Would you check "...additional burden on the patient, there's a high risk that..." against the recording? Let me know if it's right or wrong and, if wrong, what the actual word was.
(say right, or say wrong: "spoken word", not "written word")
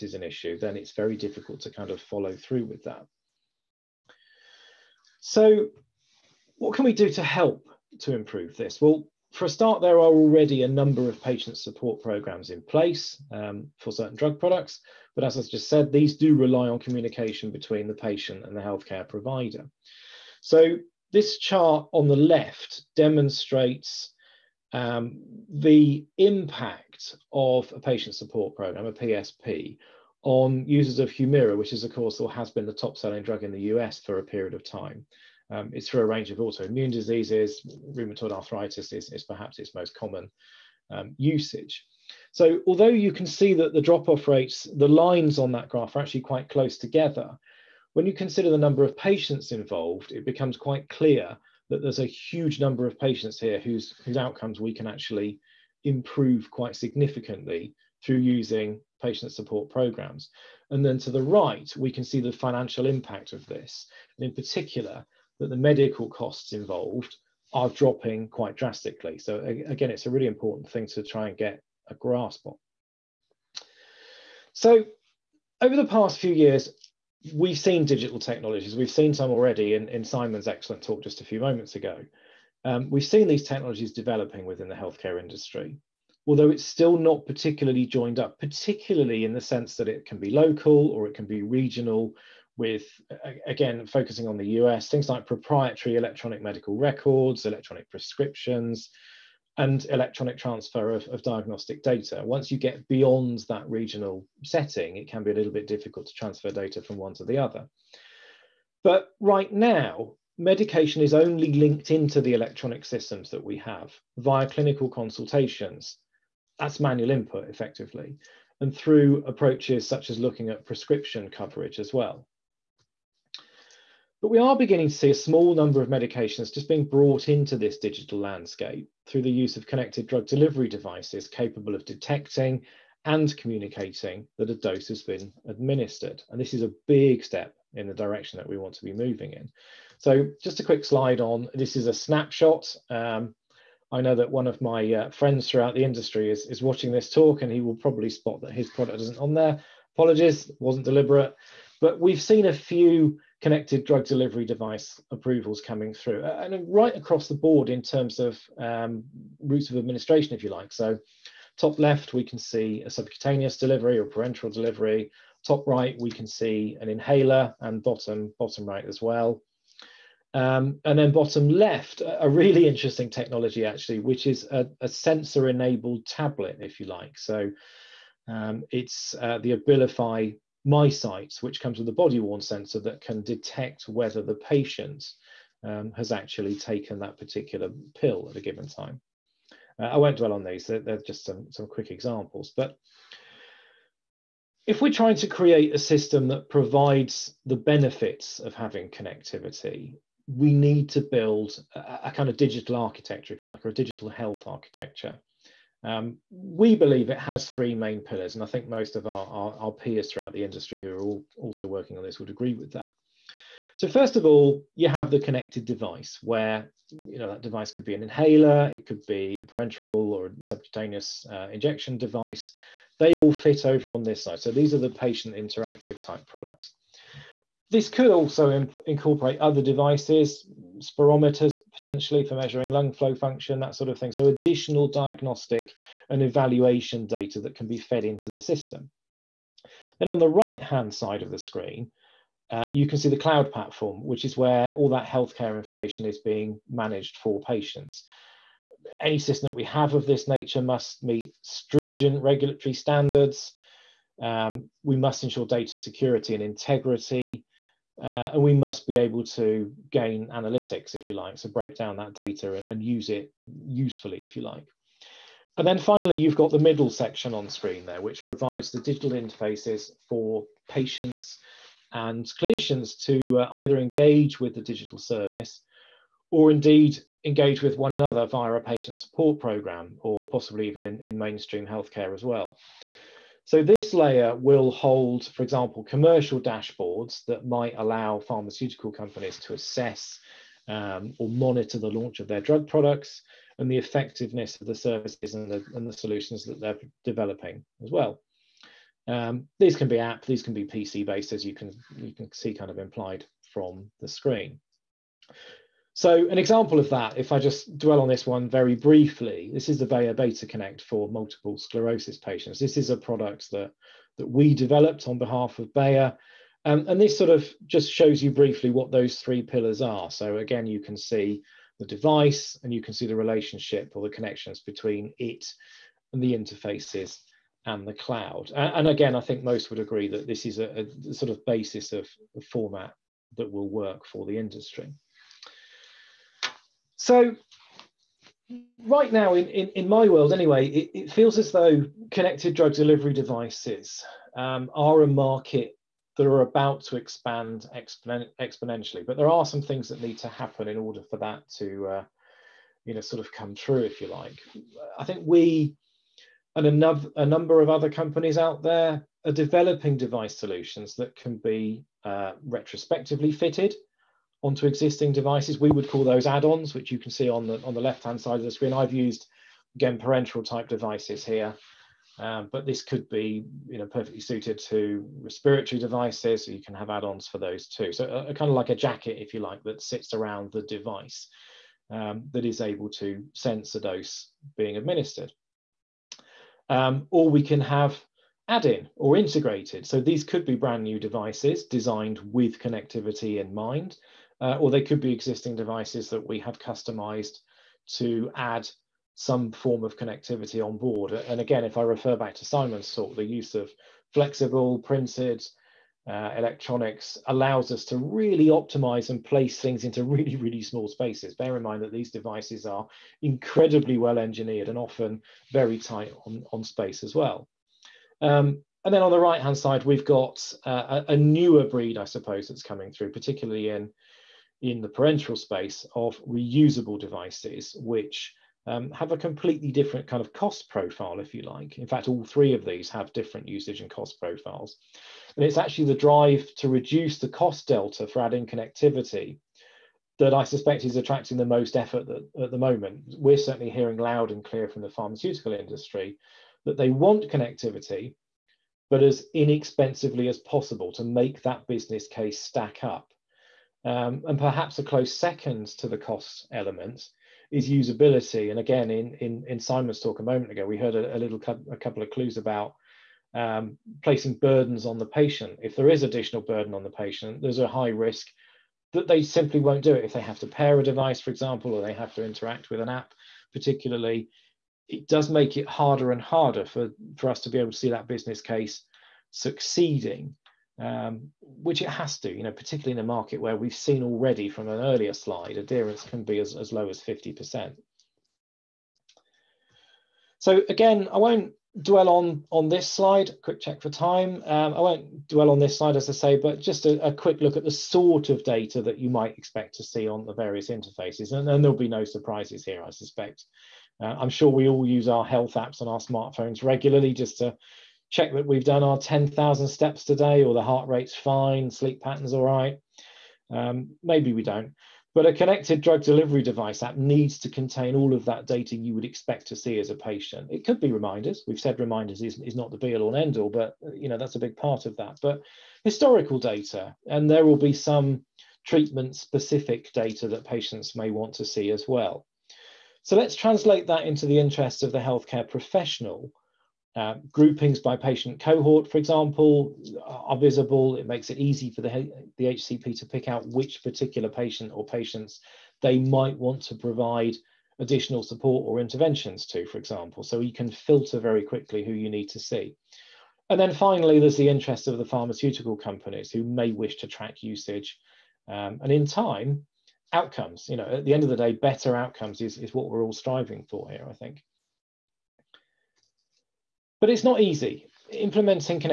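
right.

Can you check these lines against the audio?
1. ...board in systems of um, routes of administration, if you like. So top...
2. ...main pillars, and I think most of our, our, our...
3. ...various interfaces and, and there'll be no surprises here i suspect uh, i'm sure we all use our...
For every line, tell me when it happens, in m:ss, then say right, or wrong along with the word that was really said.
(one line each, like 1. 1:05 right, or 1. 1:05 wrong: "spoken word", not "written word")
1. 2:37 wrong: "terms", not "systems"
2. 3:27 right
3. 8:20 right.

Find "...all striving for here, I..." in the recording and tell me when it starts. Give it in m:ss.
9:23.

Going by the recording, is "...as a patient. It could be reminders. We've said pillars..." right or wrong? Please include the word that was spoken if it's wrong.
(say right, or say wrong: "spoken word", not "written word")
wrong: "reminders", not "pillars".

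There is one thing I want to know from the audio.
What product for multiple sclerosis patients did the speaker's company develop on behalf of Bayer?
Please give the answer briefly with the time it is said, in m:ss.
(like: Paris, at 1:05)
Bayer Beta Connect, at 5:09.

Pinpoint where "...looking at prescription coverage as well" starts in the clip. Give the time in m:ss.
2:00.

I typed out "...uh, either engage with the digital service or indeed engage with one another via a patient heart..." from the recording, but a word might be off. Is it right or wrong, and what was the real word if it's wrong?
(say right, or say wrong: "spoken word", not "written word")
wrong: "support", not "heart".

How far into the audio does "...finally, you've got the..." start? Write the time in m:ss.
4:25.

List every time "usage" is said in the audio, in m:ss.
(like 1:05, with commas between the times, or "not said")
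0:41, 7:13, 9:17.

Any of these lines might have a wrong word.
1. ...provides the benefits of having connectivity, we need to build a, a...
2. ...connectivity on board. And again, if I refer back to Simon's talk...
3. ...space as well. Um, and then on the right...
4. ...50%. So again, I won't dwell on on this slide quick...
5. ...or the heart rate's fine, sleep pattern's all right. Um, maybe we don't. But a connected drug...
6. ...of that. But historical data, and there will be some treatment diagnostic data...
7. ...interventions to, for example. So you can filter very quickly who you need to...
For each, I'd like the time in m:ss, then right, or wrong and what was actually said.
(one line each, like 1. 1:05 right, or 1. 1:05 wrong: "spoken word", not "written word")
1. 3:16 right
2. 6:39 right
3. 6:56 right
4. 8:07 right
5. 8:30 right
6. 8:44 wrong: "specific", not "diagnostic"
7. 9:08 right.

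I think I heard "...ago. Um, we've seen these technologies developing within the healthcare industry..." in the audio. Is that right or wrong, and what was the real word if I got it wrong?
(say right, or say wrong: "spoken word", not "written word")
right.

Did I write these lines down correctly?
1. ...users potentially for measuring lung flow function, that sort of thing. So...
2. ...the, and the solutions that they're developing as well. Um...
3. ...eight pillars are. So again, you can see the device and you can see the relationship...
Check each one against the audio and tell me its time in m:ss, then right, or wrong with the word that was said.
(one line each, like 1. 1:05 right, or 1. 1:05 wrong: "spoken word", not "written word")
1. 3:50 wrong: "spirometers", not "users"
2. 4:55 right
3. 5:19 wrong: "three", not "eight".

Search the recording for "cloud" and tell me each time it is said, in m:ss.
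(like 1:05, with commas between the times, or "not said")
4:03, 5:27.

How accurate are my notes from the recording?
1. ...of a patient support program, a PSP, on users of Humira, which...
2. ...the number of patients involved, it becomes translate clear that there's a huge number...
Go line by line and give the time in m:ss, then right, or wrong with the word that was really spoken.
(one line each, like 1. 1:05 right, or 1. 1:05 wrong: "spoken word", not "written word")
1. 0:27 right
2. 0:48 wrong: "quite", not "translate".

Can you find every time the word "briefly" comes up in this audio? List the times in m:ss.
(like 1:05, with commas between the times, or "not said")
5:08, 5:18.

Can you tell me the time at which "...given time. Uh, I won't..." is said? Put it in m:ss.
3:08.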